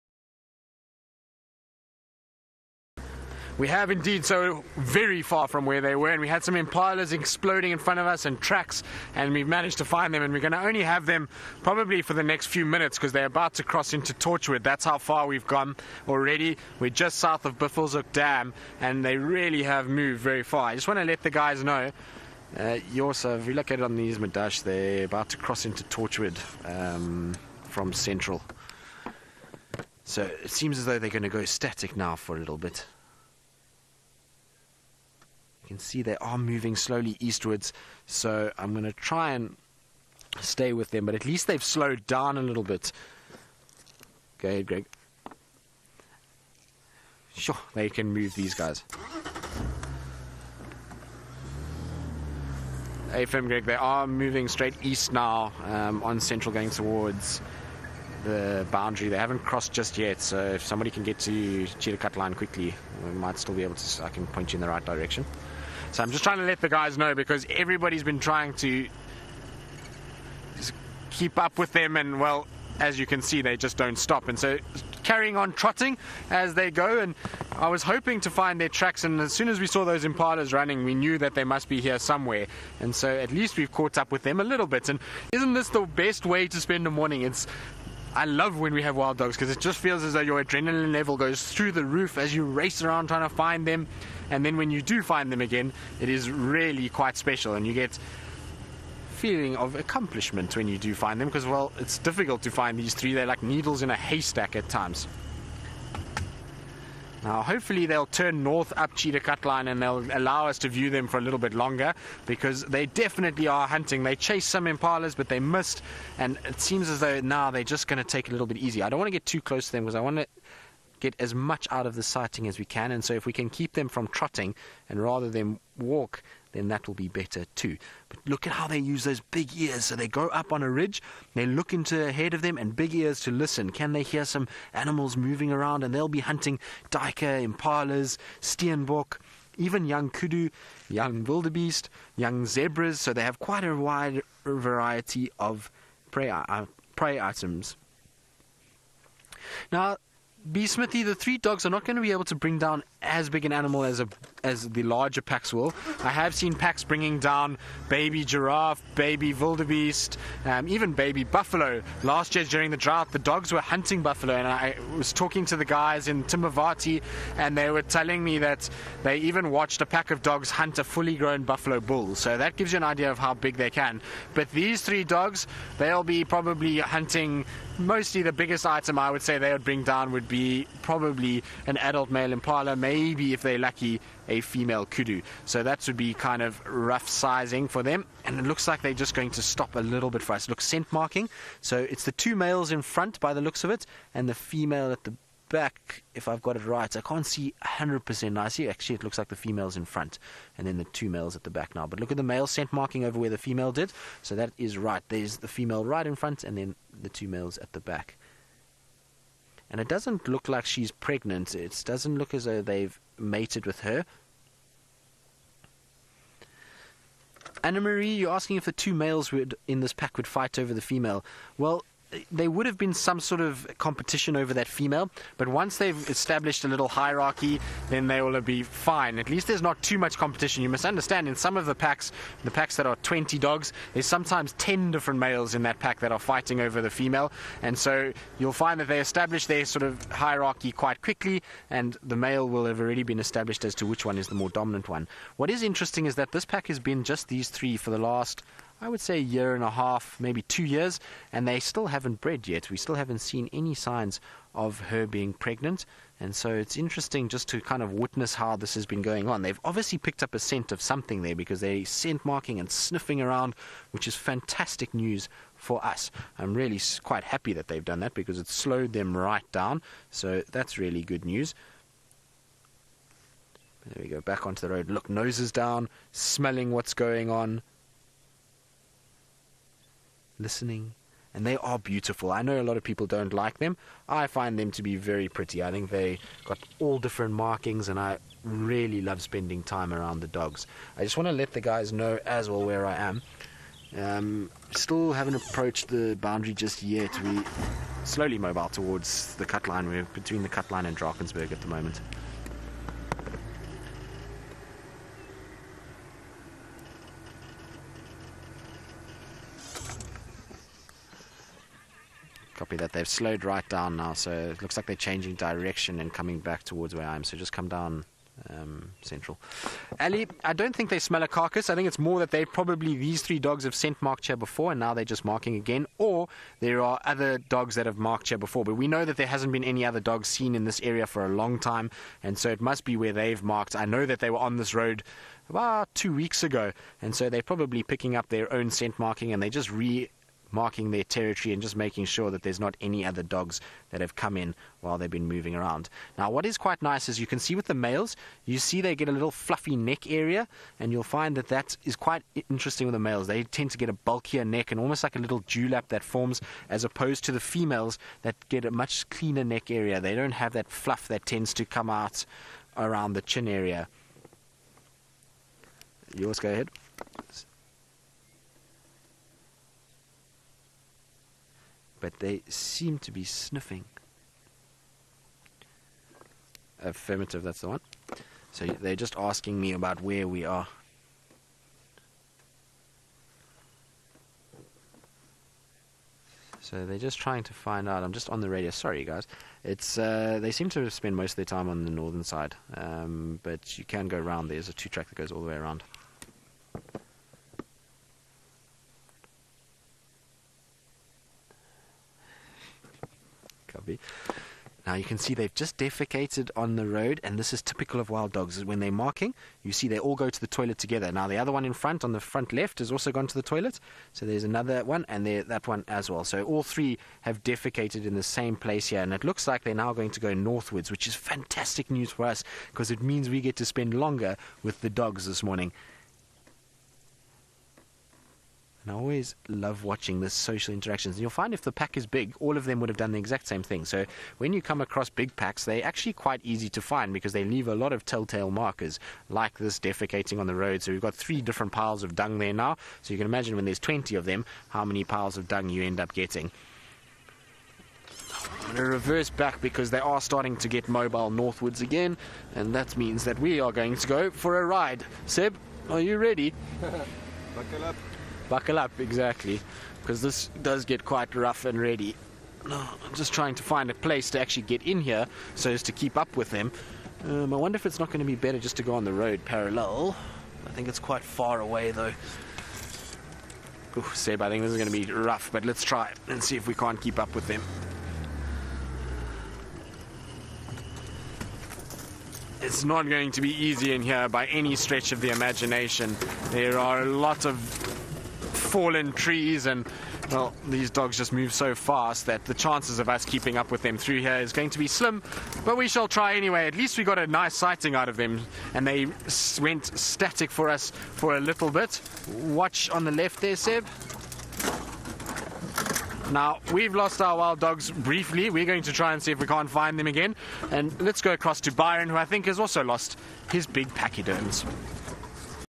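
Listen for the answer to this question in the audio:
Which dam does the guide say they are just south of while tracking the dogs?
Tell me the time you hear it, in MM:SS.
00:17.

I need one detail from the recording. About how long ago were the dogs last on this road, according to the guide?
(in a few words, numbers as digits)
2 weeks.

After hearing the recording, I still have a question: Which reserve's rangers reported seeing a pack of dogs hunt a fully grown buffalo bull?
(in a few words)
Timbavati.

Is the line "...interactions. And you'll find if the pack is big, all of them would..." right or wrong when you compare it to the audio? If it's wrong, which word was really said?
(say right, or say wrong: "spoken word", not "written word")
right.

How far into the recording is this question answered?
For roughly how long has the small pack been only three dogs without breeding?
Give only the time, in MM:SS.
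04:09.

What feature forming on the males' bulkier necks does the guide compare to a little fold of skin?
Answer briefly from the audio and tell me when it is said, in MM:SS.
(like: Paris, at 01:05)
Dewlap, at 05:55.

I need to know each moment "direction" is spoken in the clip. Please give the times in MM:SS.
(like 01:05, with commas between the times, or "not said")
01:04, 05:15.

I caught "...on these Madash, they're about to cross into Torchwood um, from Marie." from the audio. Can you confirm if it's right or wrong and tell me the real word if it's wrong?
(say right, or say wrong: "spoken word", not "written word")
wrong: "Central", not "Marie".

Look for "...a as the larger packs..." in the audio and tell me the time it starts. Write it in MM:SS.
02:33.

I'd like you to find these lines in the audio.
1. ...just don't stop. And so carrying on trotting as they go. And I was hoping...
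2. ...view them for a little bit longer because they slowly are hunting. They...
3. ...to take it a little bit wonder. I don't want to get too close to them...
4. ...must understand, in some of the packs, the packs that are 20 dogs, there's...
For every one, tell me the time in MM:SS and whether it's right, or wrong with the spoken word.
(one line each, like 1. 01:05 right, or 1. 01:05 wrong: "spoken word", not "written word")
1. 01:13 right
2. 01:50 wrong: "definitely", not "slowly"
3. 01:57 wrong: "easier", not "wonder"
4. 03:50 right.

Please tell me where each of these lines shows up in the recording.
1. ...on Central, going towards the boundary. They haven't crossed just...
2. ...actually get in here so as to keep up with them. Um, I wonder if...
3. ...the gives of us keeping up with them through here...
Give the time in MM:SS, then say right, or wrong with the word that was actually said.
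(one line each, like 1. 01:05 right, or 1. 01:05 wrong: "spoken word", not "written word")
1. 00:56 right
2. 07:44 right
3. 08:12 wrong: "chances", not "gives".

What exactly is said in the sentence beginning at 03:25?
There's the female right in front and then the two males at the back and it doesn't look like she's pregnant.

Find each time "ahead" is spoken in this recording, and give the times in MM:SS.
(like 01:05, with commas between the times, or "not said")
00:44, 02:12, 06:06.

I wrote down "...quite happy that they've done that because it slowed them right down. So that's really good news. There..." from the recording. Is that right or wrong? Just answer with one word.
right.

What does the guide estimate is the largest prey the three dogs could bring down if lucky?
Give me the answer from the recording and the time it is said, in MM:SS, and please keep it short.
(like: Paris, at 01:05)
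A female kudu, at 03:04.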